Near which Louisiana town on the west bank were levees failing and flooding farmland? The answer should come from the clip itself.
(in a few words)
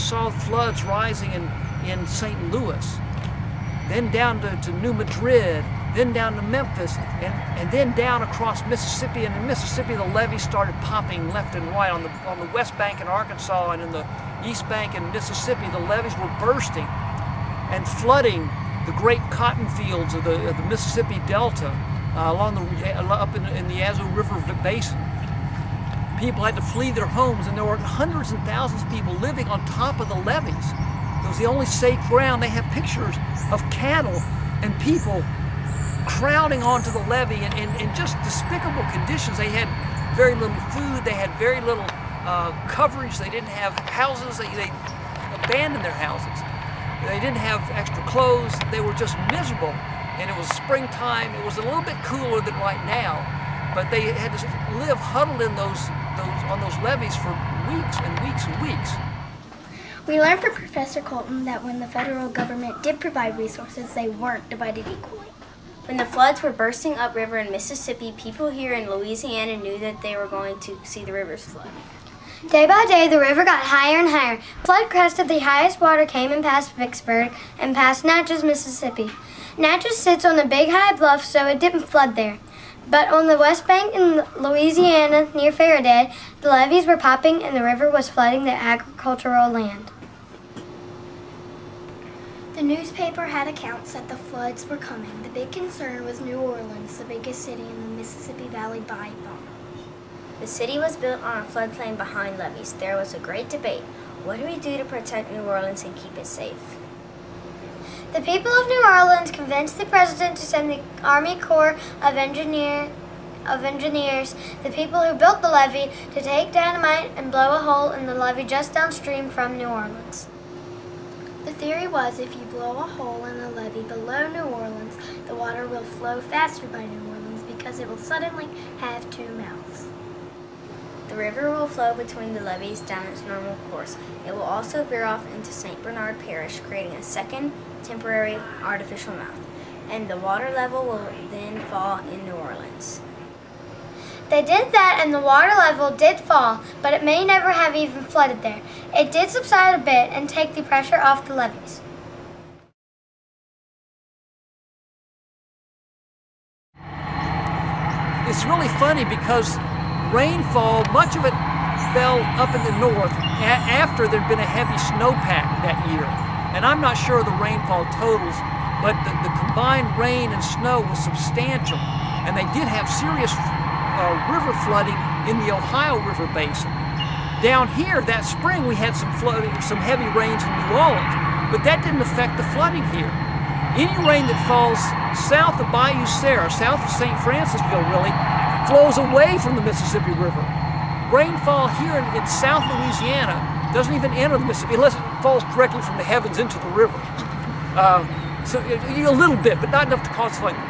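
Ferriday.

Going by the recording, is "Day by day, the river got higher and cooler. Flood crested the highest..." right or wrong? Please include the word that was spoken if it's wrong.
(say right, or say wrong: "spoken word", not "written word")
wrong: "higher", not "cooler".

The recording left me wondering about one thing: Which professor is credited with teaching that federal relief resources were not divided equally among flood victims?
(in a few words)
Professor Colten.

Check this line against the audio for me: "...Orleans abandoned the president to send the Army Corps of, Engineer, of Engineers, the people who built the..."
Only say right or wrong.
wrong.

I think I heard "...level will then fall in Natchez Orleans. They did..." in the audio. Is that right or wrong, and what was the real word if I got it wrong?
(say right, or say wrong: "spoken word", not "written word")
wrong: "New", not "Natchez".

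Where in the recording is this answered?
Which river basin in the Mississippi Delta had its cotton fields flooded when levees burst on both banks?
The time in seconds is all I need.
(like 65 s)
23 s.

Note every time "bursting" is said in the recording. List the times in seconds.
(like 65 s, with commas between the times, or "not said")
16 s, 66 s.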